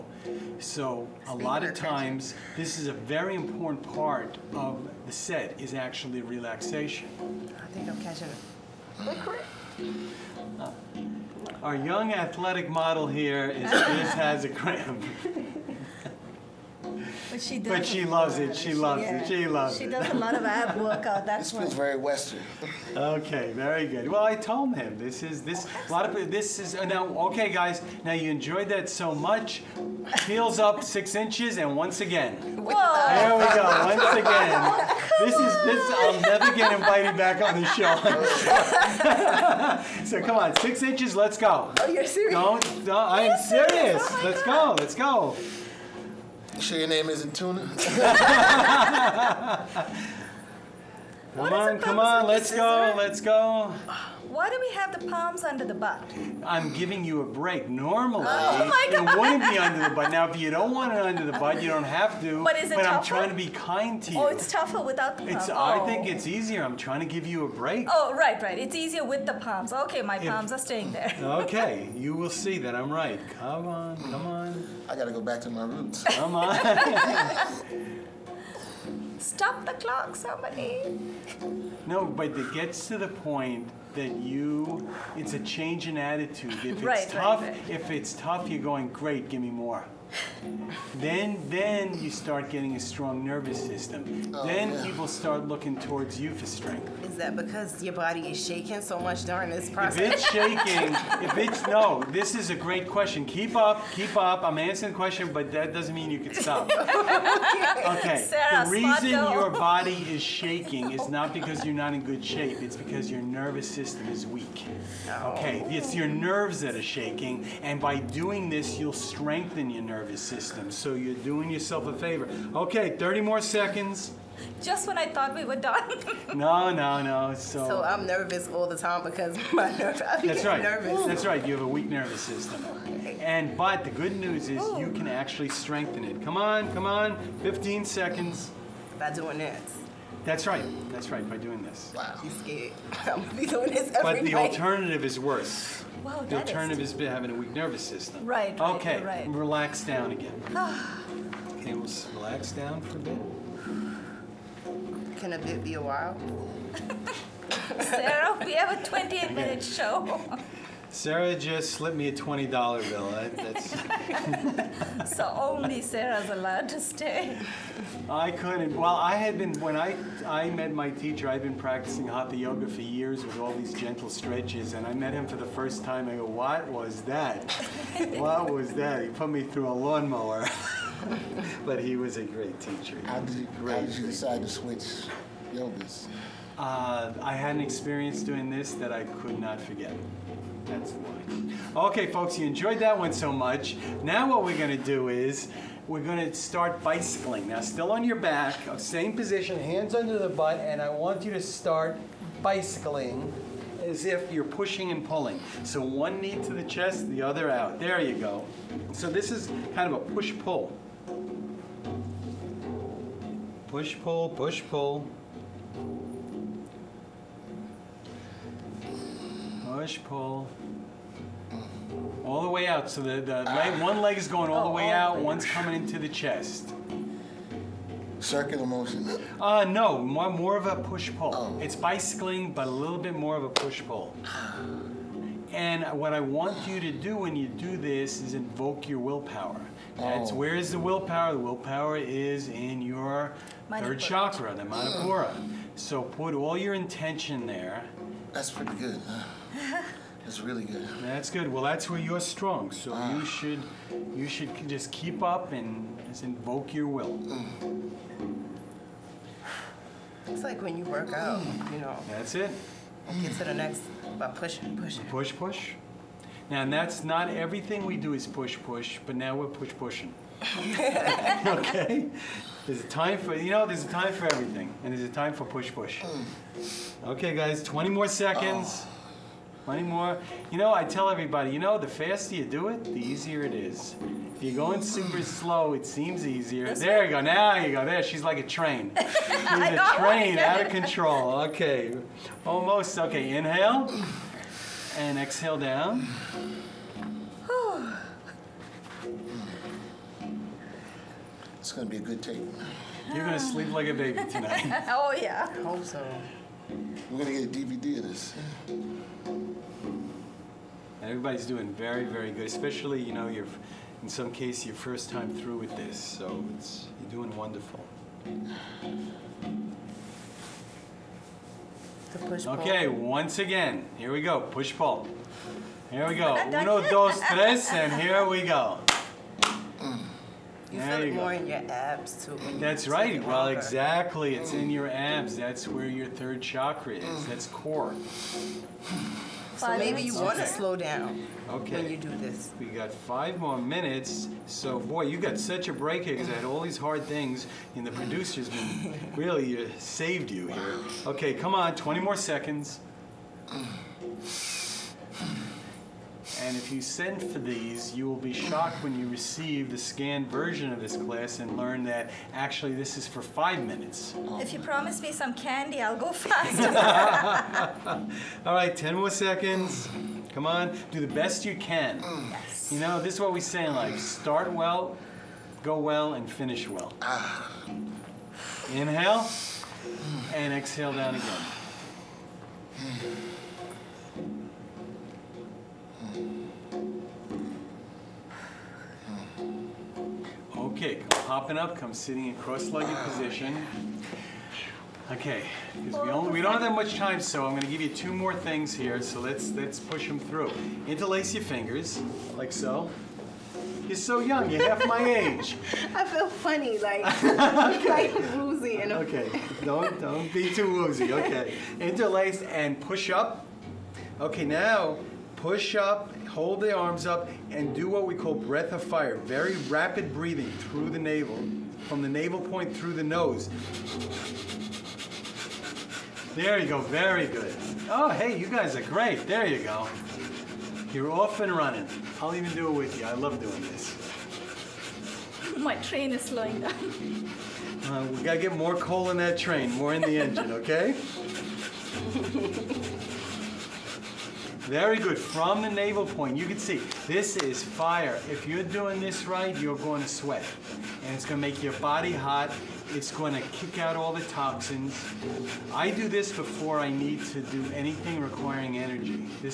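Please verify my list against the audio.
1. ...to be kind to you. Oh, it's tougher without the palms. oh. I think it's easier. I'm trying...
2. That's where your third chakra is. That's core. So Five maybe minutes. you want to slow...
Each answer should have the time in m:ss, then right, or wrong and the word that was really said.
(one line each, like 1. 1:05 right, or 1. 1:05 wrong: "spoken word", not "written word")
1. 1:03 right
2. 5:35 right.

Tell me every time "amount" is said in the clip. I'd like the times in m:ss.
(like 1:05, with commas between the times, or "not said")
not said.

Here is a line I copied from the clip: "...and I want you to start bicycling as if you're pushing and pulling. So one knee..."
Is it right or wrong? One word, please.
right.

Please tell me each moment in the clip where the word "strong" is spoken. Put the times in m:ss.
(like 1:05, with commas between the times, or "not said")
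1:32, 4:12.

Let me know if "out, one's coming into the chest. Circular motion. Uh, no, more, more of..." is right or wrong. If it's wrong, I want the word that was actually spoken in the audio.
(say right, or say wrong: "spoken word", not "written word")
right.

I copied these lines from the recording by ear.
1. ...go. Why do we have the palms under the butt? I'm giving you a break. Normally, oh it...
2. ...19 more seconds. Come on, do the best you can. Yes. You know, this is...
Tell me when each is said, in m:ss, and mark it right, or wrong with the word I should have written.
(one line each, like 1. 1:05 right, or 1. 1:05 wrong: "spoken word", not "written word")
1. 0:53 right
2. 6:08 wrong: "10", not "19".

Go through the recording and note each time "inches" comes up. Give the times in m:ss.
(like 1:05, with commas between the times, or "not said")
0:31, 0:40.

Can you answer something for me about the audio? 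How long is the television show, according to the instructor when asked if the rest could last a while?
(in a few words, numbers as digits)
28 minutes.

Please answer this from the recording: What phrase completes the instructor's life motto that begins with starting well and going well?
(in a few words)
finish well.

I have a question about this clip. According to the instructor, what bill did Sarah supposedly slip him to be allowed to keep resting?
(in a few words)
$20 bill.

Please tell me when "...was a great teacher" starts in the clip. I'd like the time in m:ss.
3:01.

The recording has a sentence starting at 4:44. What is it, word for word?
If you're going super slow, it seems easier.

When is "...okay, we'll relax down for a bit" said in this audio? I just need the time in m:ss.
2:31.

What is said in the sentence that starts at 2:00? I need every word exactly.
So you're doing yourself a favor.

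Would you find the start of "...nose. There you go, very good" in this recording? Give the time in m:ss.
7:03.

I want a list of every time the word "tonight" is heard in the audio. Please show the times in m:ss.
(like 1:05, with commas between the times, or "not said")
5:04.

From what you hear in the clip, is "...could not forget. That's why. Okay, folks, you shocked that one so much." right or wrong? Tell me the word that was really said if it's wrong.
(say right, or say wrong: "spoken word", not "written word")
wrong: "enjoyed", not "shocked".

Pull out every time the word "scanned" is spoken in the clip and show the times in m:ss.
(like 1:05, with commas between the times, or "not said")
5:59.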